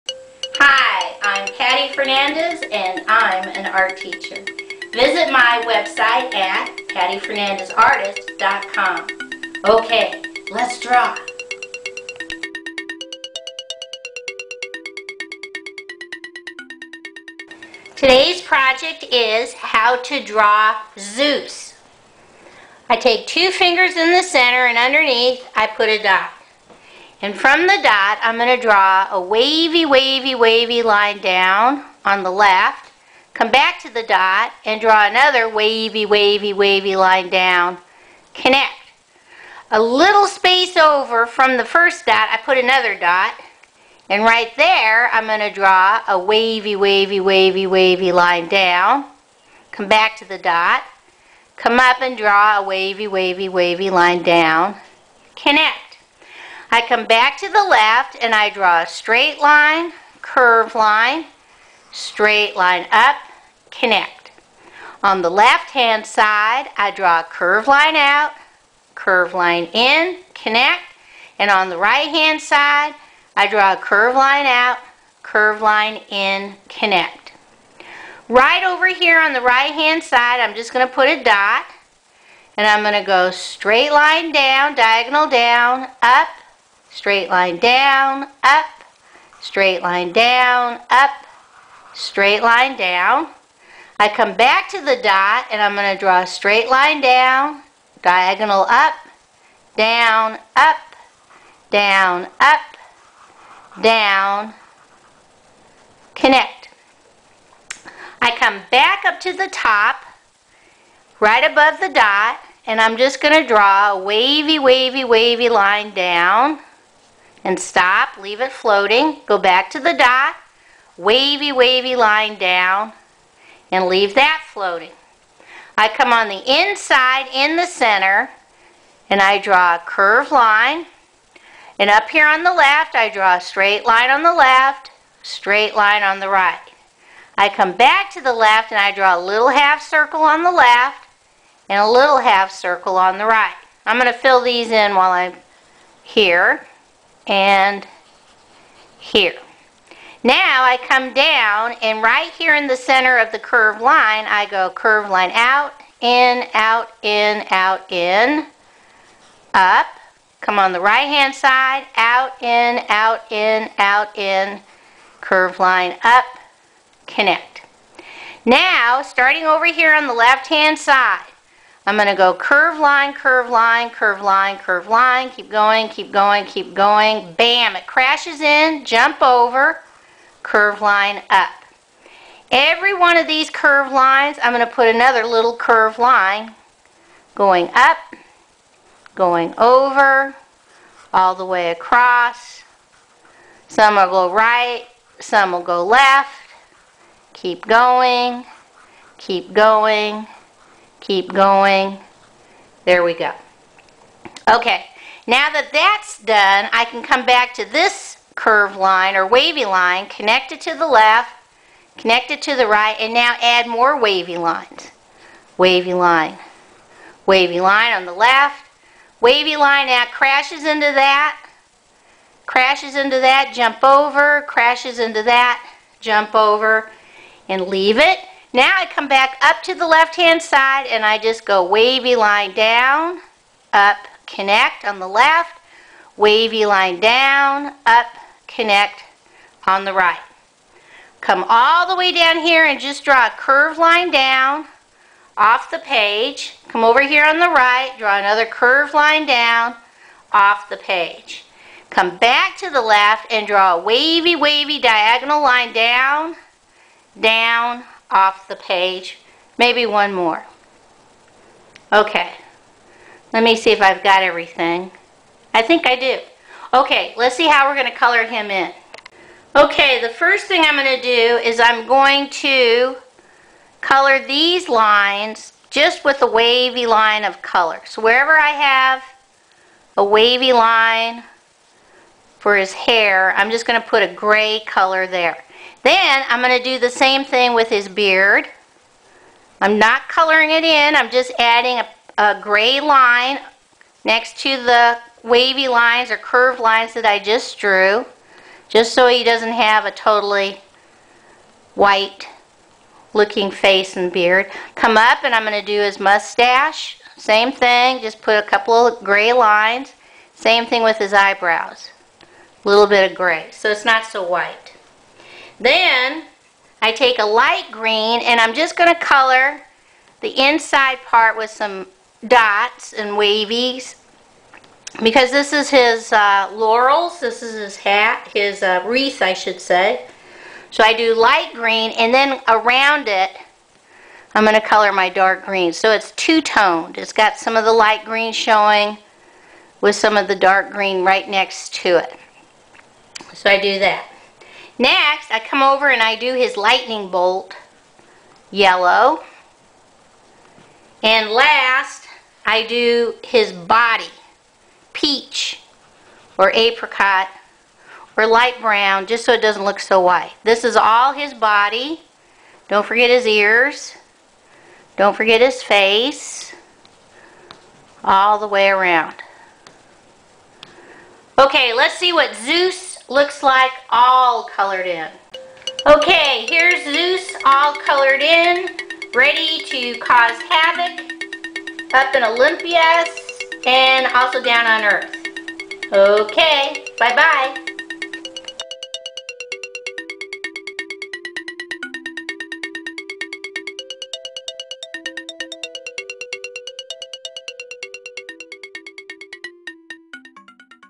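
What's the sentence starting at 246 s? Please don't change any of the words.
Come over here on the right, draw another curved line down off the page.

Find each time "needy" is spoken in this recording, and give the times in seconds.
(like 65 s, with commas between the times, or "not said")
not said.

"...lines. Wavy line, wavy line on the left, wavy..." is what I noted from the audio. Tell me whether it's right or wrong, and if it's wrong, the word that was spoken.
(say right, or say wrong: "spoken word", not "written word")
right.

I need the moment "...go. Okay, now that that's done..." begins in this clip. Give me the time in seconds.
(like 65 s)
203 s.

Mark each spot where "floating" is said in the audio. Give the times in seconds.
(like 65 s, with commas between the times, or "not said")
118 s, 124 s.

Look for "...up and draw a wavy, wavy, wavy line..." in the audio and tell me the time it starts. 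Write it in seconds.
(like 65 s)
51 s.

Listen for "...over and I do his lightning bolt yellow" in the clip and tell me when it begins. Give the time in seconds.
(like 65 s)
345 s.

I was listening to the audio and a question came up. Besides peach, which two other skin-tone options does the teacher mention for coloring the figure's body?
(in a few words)
apricot or light brown.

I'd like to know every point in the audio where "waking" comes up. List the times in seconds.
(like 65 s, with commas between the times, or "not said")
not said.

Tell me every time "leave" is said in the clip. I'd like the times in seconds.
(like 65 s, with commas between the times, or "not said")
118 s, 123 s, 227 s.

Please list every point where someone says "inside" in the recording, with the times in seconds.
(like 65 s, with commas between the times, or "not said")
126 s, 320 s.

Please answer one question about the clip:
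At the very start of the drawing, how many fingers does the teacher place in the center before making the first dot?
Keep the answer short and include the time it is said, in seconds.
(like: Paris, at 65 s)
2, at 23 s.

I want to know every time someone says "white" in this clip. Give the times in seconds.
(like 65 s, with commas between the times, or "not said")
301 s, 314 s, 360 s.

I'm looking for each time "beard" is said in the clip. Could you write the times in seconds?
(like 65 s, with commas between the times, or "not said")
287 s, 304 s.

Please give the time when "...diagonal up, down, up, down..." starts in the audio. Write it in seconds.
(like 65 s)
98 s.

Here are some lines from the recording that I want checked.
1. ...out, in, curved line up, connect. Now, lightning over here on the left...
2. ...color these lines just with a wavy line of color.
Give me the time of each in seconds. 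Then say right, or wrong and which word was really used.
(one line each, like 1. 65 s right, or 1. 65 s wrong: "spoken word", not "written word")
1. 163 s wrong: "starting", not "lightning"
2. 273 s right.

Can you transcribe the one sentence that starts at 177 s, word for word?
Bam, it crashes in, jump over, curve line up.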